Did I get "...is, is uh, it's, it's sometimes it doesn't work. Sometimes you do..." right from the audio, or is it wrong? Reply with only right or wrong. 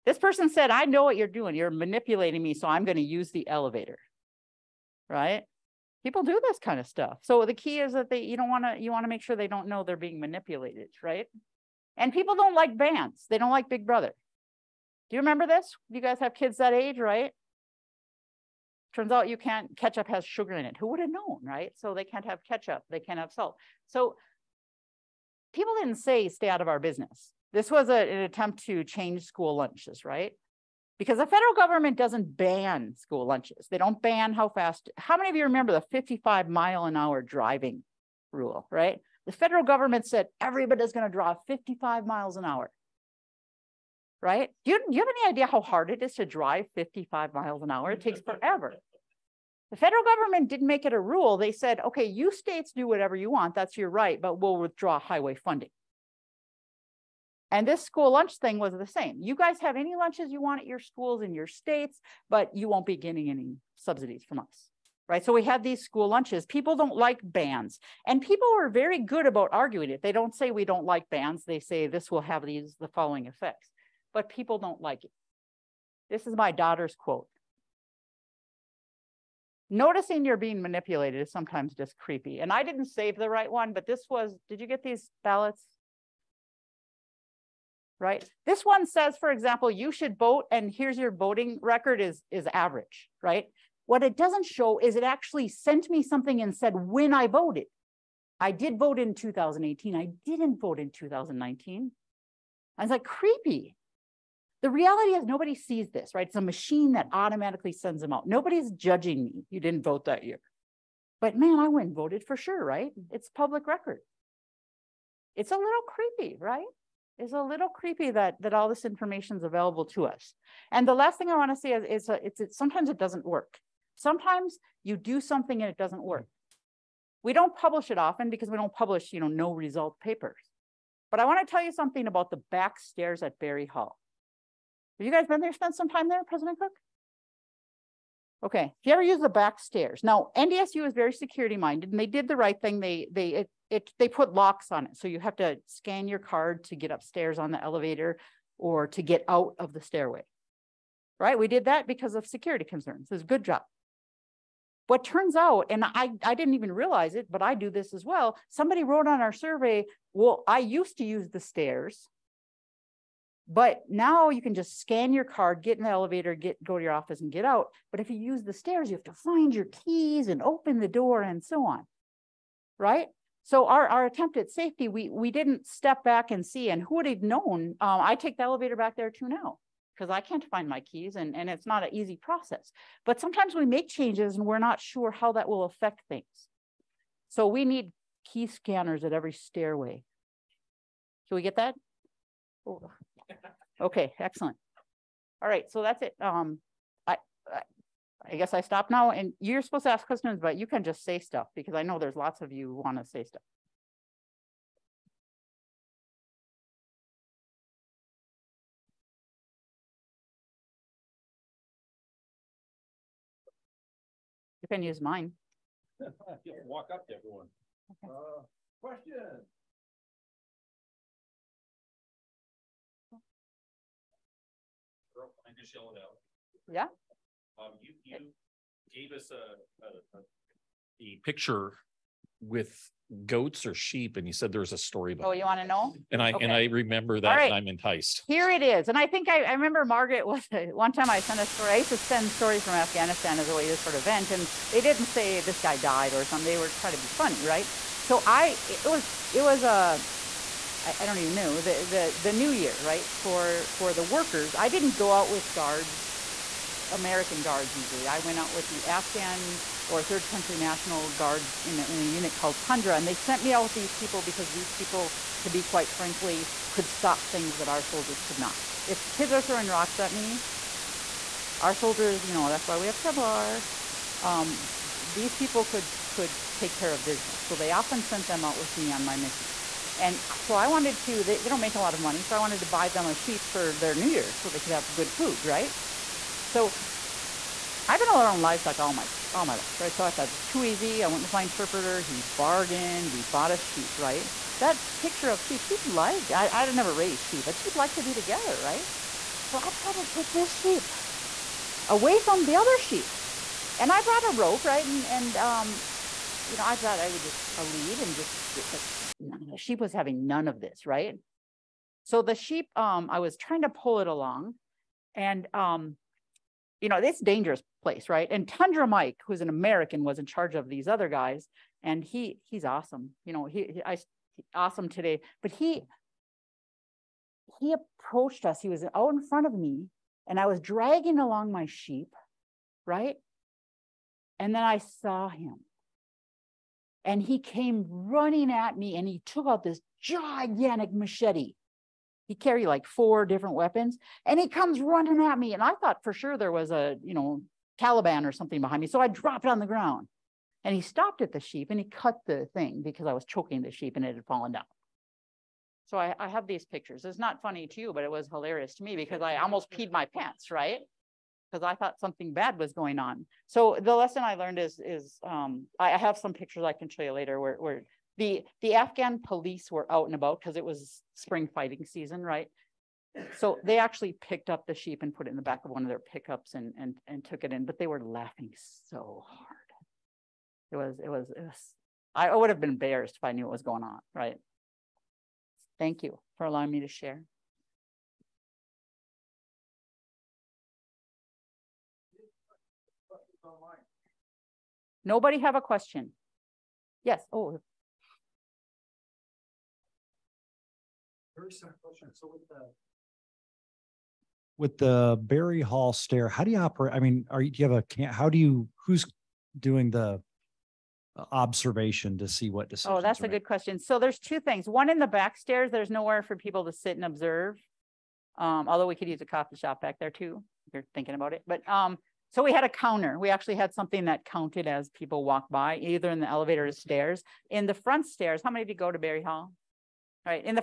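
right.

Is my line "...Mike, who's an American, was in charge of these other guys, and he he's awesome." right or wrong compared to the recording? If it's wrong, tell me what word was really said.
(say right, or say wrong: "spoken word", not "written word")
right.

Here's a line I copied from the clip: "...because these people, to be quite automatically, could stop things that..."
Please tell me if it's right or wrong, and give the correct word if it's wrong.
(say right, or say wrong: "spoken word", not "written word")
wrong: "frankly", not "automatically".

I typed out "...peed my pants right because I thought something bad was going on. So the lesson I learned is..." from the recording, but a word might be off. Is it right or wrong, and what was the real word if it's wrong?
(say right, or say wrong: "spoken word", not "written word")
right.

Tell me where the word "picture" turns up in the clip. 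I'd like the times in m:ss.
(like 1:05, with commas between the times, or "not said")
3:51, 4:54, 5:56, 6:06.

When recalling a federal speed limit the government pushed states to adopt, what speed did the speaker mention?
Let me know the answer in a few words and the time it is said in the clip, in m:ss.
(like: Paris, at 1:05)
55 miles an hour, at 0:35.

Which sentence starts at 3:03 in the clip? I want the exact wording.
But sometimes we make changes and we're not sure how that will affect things.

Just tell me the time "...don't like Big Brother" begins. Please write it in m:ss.
0:13.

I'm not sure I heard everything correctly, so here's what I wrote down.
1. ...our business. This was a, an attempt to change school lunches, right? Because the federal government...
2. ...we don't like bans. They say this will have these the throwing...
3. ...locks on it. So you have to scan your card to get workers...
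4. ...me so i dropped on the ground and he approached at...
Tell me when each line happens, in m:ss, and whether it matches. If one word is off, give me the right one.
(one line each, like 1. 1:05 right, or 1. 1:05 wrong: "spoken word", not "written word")
1. 0:26 right
2. 1:10 wrong: "following", not "throwing"
3. 2:24 wrong: "upstairs", not "workers"
4. 5:48 wrong: "stopped", not "approached".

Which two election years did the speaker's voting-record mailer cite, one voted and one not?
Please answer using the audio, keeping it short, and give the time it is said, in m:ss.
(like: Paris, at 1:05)
2018 and 2019, at 1:39.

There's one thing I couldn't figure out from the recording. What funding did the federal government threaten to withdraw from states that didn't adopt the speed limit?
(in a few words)
highway funding.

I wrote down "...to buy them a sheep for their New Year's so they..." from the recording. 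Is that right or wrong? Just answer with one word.
right.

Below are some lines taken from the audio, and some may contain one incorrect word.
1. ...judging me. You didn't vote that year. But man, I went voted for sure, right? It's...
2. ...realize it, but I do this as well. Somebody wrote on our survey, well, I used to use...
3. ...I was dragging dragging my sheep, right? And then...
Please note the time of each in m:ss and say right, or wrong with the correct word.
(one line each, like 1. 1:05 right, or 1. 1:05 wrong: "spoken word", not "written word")
1. 1:48 right
2. 2:36 right
3. 5:30 wrong: "along", not "dragging".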